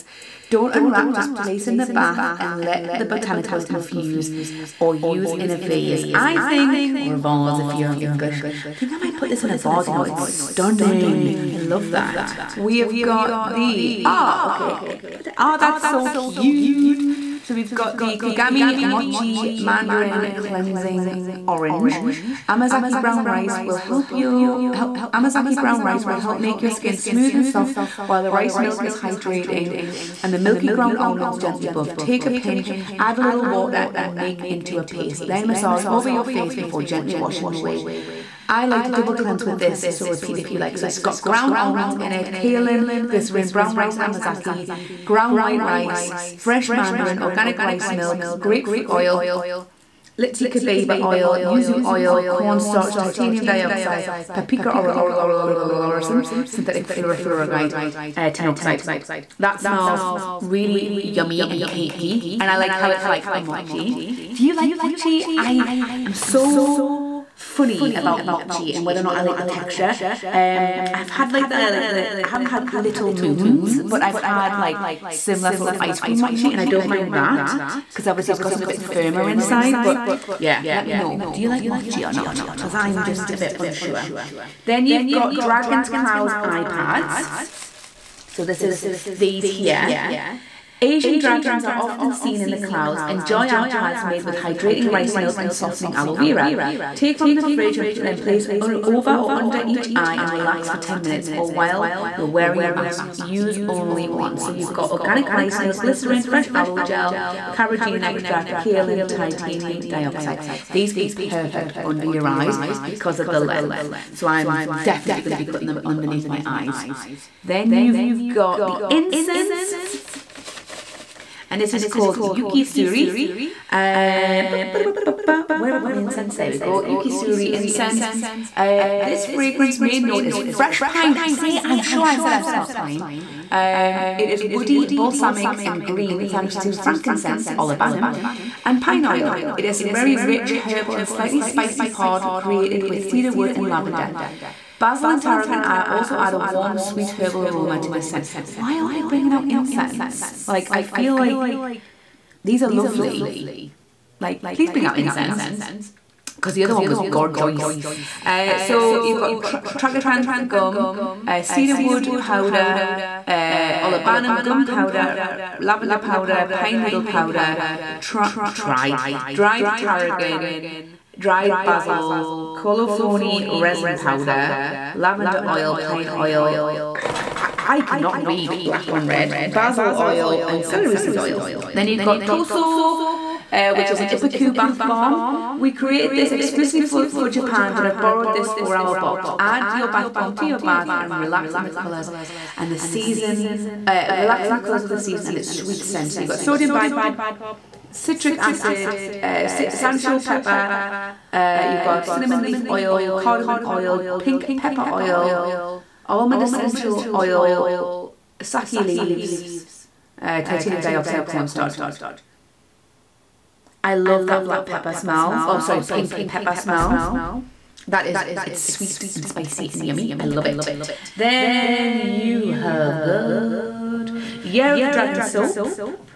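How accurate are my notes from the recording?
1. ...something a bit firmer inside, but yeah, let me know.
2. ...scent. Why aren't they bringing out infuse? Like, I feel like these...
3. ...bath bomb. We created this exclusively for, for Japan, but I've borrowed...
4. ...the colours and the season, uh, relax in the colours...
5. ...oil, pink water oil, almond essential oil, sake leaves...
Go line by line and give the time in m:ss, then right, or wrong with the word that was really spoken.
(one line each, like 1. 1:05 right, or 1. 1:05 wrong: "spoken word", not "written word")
1. 1:18 right
2. 2:28 wrong: "incense", not "infuse"
3. 3:04 right
4. 3:11 right
5. 3:23 wrong: "pepper", not "water".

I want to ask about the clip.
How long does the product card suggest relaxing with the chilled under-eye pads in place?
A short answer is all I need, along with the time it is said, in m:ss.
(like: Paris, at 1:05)
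10 minutes, at 1:40.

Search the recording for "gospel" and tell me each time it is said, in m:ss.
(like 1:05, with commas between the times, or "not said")
not said.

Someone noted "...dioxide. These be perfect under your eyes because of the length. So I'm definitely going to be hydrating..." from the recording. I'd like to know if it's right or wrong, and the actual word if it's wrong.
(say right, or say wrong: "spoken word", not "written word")
wrong: "putting", not "hydrating".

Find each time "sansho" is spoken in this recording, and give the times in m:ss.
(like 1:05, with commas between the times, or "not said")
3:19.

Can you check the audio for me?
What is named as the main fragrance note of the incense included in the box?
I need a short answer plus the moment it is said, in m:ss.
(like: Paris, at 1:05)
Fresh pine, at 2:10.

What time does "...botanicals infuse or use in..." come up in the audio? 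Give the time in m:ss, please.
0:03.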